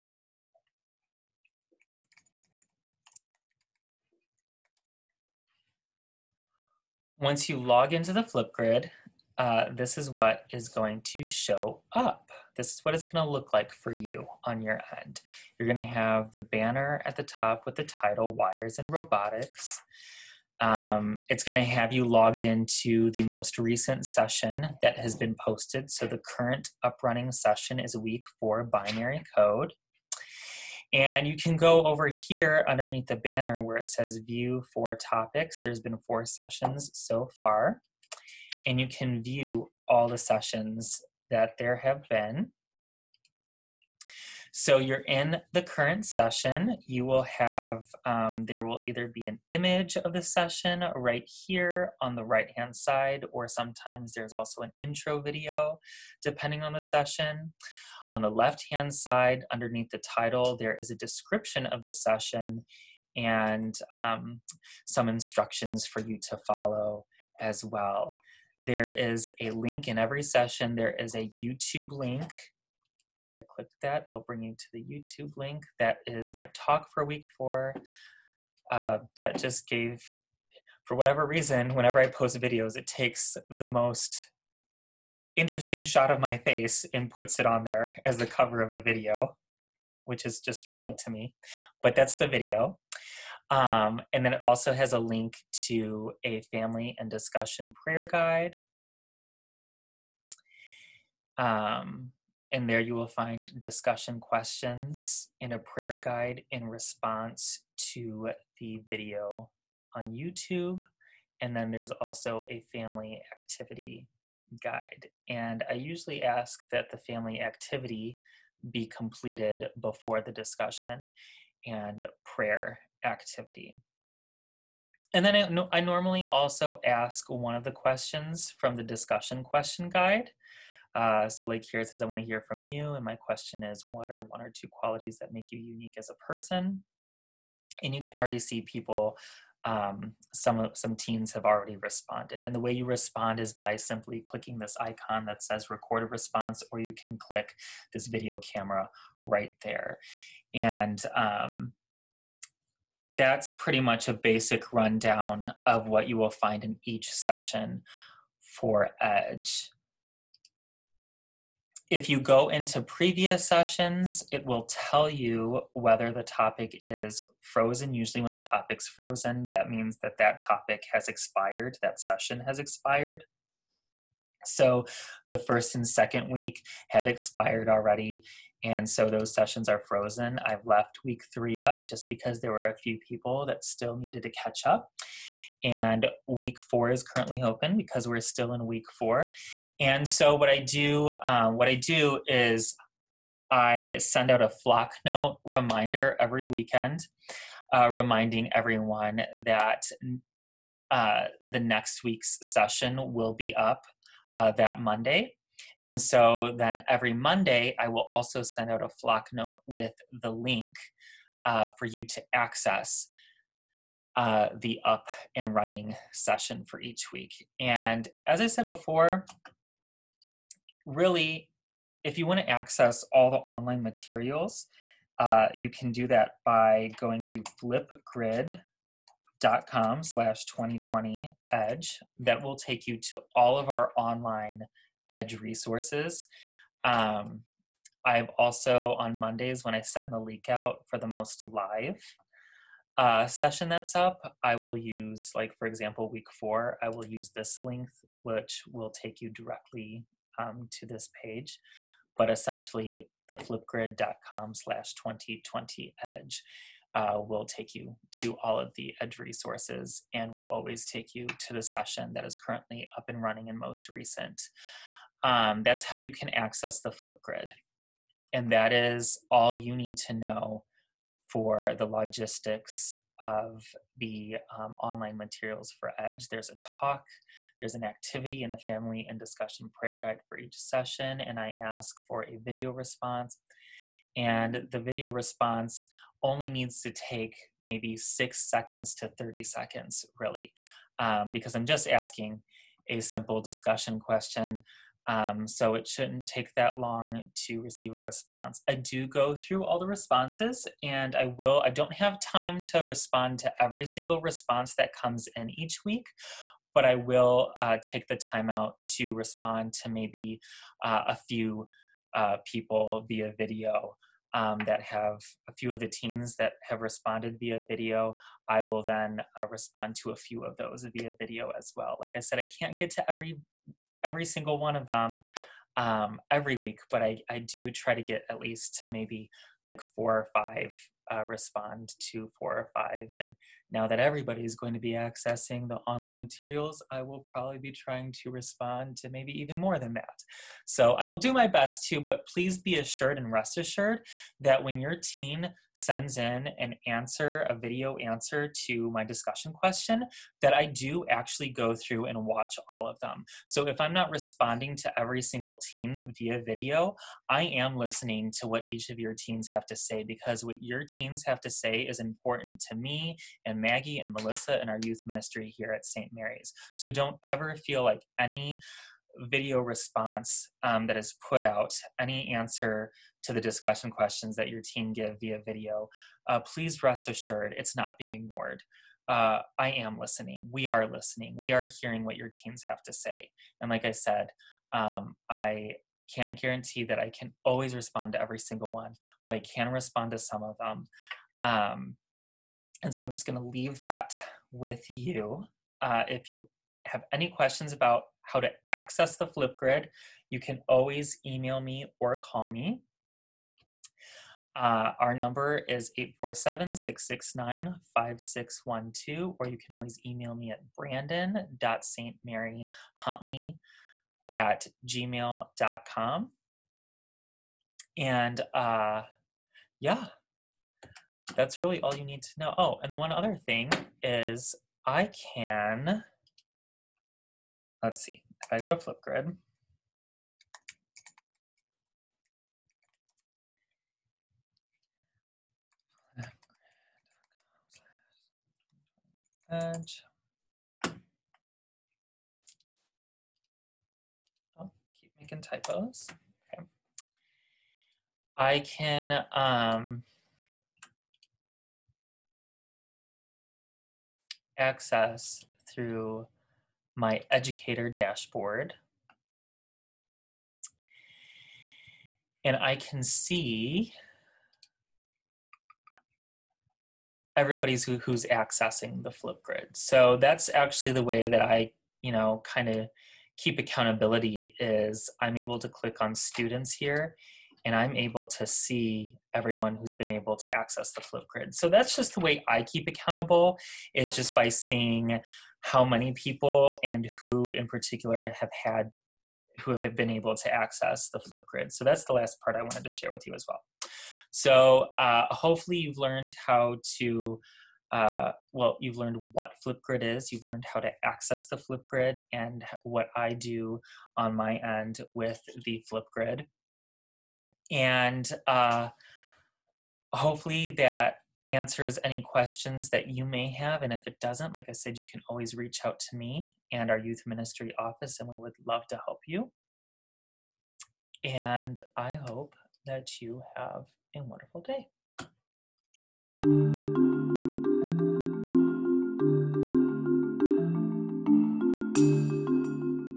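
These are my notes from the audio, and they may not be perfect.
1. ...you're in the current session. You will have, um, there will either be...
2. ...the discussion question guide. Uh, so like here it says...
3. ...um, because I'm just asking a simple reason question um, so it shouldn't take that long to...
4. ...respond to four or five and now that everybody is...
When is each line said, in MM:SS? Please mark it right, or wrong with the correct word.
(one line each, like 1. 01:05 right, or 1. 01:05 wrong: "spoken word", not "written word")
1. 00:44 right
2. 02:08 right
3. 04:50 wrong: "discussion", not "reason"
4. 05:31 right.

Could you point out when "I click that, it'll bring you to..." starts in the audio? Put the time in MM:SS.
01:13.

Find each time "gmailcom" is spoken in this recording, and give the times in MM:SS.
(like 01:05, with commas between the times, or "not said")
06:54.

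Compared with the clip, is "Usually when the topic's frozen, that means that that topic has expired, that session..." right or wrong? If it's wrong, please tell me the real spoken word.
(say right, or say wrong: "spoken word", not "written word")
right.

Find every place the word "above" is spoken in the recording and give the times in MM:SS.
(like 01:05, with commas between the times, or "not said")
not said.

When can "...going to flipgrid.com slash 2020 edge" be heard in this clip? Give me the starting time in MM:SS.
03:46.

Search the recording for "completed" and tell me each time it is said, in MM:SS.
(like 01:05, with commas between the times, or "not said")
01:58.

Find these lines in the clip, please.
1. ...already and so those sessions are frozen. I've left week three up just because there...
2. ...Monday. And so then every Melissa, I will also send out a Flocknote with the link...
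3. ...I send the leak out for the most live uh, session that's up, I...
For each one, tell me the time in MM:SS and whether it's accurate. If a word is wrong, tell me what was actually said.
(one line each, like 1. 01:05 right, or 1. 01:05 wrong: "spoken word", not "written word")
1. 02:57 right
2. 03:24 wrong: "Monday", not "Melissa"
3. 03:59 right.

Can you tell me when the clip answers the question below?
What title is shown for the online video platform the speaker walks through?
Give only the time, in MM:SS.
00:18.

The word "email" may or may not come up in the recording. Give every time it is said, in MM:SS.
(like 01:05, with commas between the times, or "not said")
06:41, 06:50.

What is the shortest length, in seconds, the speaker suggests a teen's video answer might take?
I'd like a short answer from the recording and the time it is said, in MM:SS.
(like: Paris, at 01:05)
6, at 04:47.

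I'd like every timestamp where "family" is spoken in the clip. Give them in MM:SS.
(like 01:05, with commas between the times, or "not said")
01:36, 01:52, 01:56, 04:38.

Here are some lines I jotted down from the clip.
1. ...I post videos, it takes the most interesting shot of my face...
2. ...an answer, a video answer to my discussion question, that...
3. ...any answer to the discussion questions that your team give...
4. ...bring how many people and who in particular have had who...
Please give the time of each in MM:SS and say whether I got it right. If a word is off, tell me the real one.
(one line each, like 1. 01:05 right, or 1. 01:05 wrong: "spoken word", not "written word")
1. 01:21 right
2. 05:46 right
3. 06:11 right
4. 08:04 wrong: "seeing", not "bring".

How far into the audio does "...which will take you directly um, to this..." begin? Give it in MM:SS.
04:08.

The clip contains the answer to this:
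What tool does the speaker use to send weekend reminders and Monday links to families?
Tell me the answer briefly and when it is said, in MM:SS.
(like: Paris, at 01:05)
Flocknote, at 03:14.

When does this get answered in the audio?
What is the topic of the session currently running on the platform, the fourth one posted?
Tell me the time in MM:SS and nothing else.
00:28.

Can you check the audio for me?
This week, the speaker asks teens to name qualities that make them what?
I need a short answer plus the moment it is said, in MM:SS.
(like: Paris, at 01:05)
unique, at 02:15.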